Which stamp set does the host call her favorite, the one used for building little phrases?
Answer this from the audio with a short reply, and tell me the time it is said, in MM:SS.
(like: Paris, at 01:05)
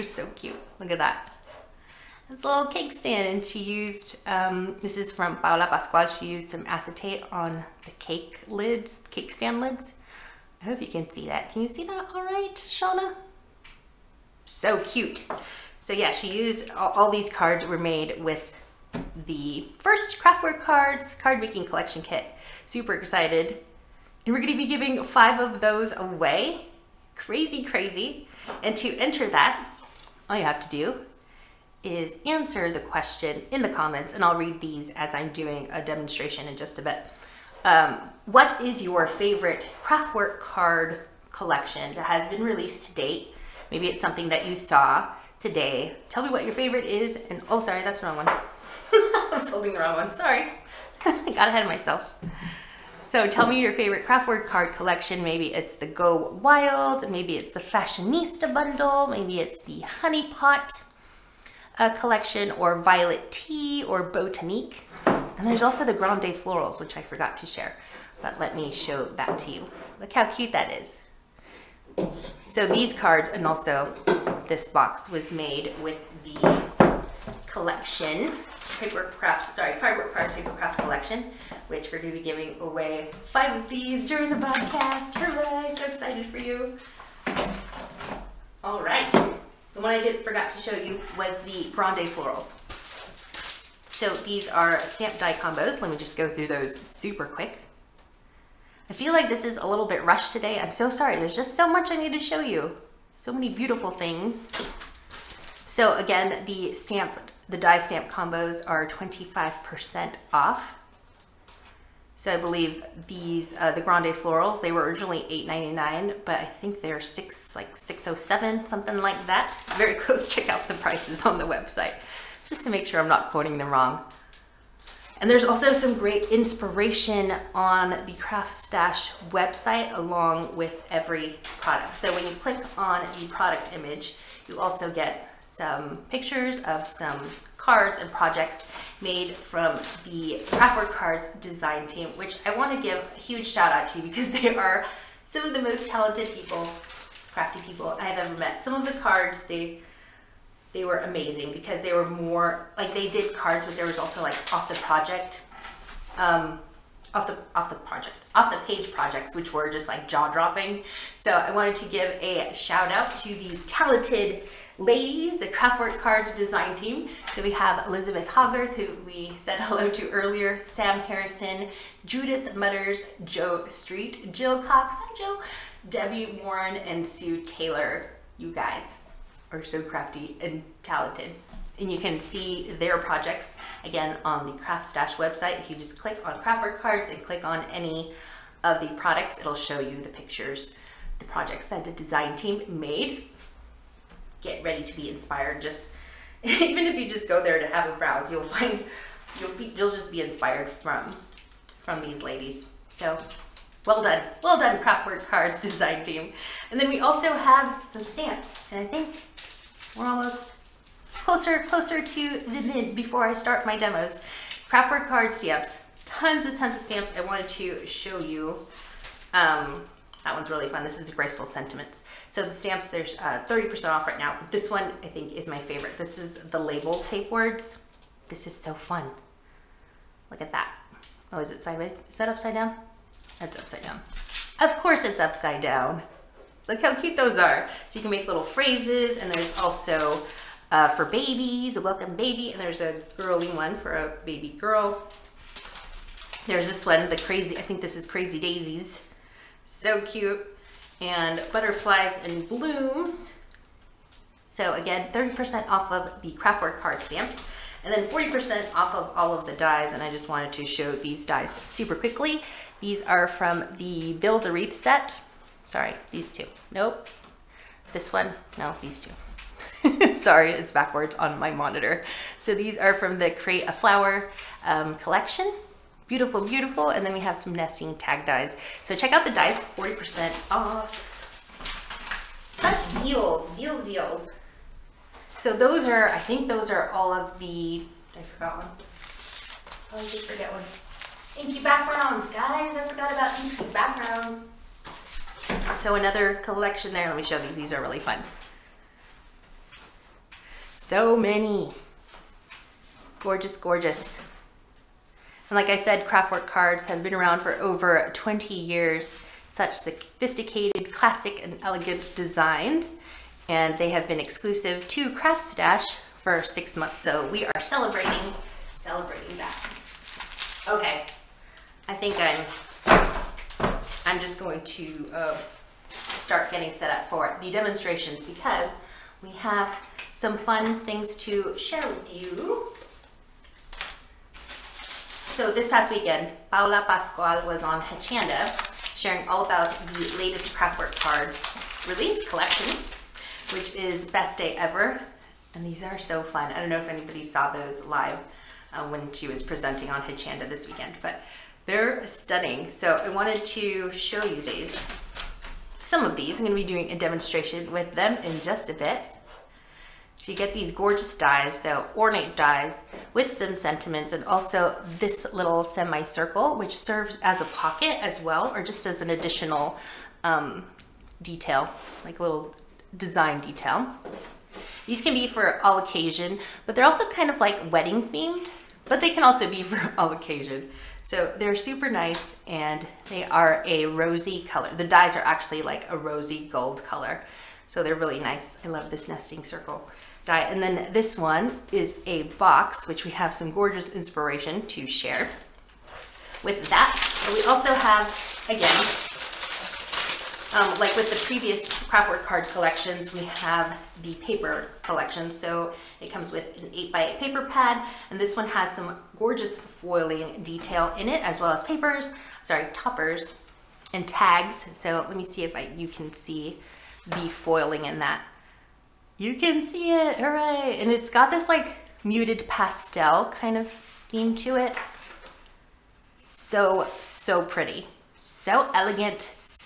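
label tape words, at 03:46.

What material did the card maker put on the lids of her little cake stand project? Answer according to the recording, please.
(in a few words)
acetate.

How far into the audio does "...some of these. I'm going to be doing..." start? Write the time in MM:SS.
05:55.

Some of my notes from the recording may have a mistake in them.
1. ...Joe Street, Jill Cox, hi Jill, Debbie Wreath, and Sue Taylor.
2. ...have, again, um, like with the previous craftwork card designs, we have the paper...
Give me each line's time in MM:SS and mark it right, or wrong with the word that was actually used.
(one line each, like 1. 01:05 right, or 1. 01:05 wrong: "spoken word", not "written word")
1. 02:53 wrong: "Warren", not "Wreath"
2. 06:37 wrong: "collections", not "designs".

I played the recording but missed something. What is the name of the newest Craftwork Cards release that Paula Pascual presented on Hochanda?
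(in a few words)
Best Day Ever.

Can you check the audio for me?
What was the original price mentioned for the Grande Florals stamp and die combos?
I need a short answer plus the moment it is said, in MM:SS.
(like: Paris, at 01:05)
$8.99, at 01:55.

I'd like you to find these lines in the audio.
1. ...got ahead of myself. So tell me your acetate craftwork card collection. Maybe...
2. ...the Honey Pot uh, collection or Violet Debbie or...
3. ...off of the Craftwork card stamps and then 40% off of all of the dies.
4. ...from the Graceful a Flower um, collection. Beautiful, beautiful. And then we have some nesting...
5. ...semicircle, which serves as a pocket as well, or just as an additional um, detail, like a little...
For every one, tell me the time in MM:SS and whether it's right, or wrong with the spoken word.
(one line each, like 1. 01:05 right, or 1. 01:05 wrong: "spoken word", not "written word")
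1. 00:51 wrong: "favorite", not "acetate"
2. 00:59 wrong: "Tea", not "Debbie"
3. 04:15 right
4. 04:32 wrong: "Create", not "Graceful"
5. 06:05 right.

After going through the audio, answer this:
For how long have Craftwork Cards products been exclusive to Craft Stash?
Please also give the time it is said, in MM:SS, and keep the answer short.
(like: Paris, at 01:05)
6 months, at 05:16.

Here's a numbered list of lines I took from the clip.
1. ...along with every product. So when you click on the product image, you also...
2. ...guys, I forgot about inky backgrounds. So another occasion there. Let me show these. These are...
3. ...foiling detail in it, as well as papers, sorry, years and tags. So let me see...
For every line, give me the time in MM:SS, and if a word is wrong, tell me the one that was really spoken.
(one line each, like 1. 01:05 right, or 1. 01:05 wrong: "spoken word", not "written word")
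1. 02:09 right
2. 04:52 wrong: "collection", not "occasion"
3. 06:49 wrong: "toppers", not "years".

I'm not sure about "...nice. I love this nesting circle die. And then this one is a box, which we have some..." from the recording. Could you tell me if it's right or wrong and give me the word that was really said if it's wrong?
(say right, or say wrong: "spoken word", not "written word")
right.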